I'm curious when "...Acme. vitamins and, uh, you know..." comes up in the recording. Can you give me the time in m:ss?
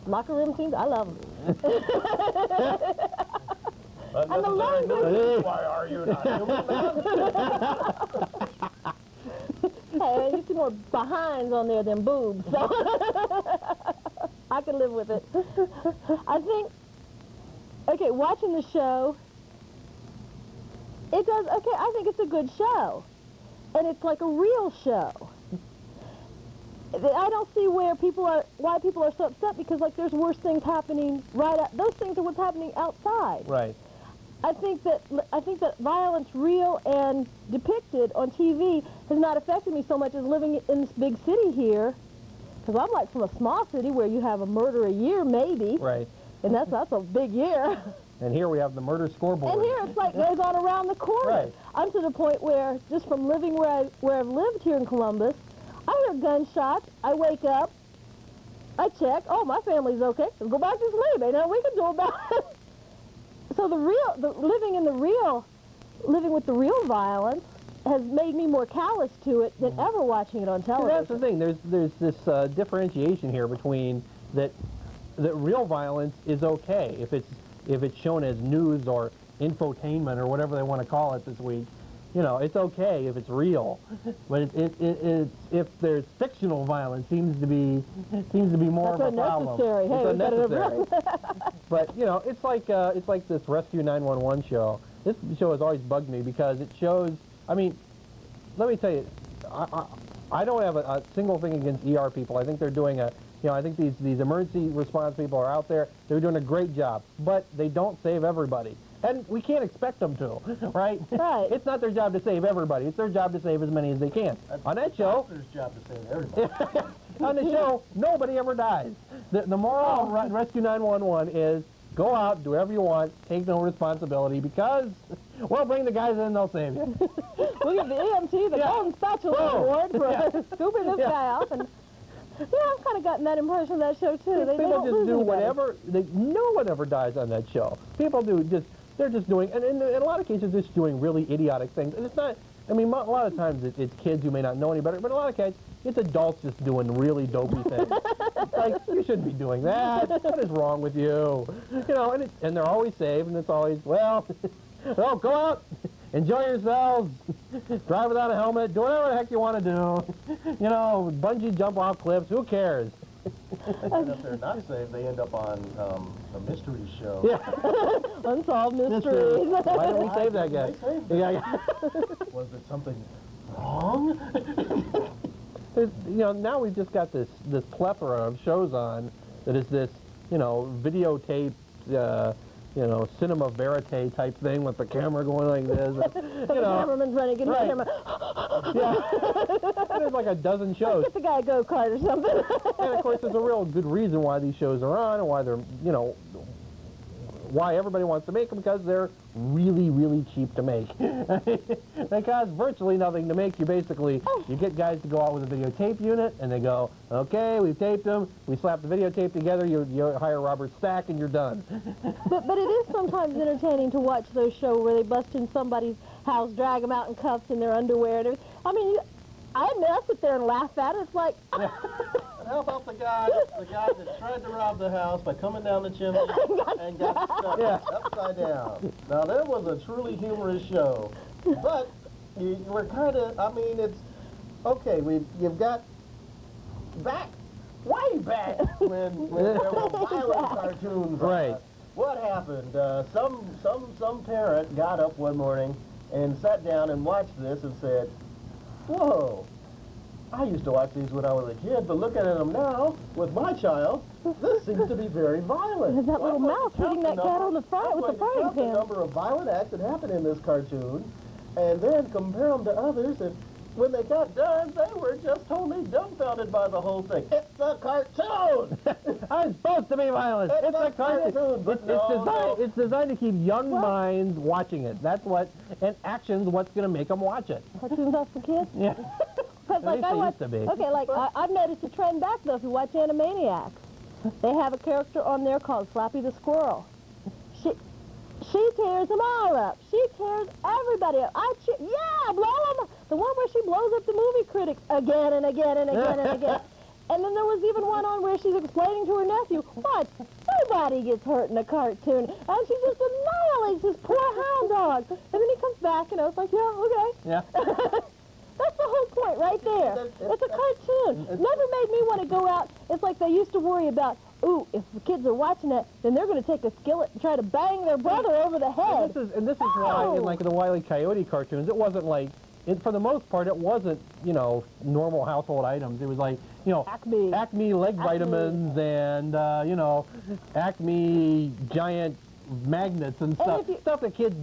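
5:27.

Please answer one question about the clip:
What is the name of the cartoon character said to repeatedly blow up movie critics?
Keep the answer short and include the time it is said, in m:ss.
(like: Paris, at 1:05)
Slappy the Squirrel, at 4:45.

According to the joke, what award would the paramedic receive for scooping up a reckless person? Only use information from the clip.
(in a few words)
Golden Spatula Award.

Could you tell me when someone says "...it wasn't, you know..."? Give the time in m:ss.
5:23.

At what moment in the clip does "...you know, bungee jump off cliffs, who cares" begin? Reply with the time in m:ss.
2:40.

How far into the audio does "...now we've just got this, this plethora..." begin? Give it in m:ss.
2:56.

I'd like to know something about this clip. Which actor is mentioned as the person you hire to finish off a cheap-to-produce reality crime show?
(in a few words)
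Robert Stack.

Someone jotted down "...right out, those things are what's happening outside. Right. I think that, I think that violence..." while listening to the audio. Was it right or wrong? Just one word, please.
right.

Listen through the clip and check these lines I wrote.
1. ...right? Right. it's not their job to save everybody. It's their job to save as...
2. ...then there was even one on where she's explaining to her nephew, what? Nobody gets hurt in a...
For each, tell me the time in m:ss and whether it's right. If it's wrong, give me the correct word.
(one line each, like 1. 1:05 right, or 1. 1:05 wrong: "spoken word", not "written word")
1. 1:50 right
2. 4:57 right.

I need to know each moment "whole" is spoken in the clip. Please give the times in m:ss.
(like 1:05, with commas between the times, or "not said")
4:26, 5:08.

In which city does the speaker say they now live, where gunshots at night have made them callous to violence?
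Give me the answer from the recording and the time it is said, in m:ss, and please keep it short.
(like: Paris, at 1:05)
Columbus, at 0:54.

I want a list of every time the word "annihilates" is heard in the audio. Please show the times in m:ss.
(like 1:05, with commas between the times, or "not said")
5:02.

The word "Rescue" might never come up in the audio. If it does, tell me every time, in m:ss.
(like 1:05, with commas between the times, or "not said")
1:33, 2:00.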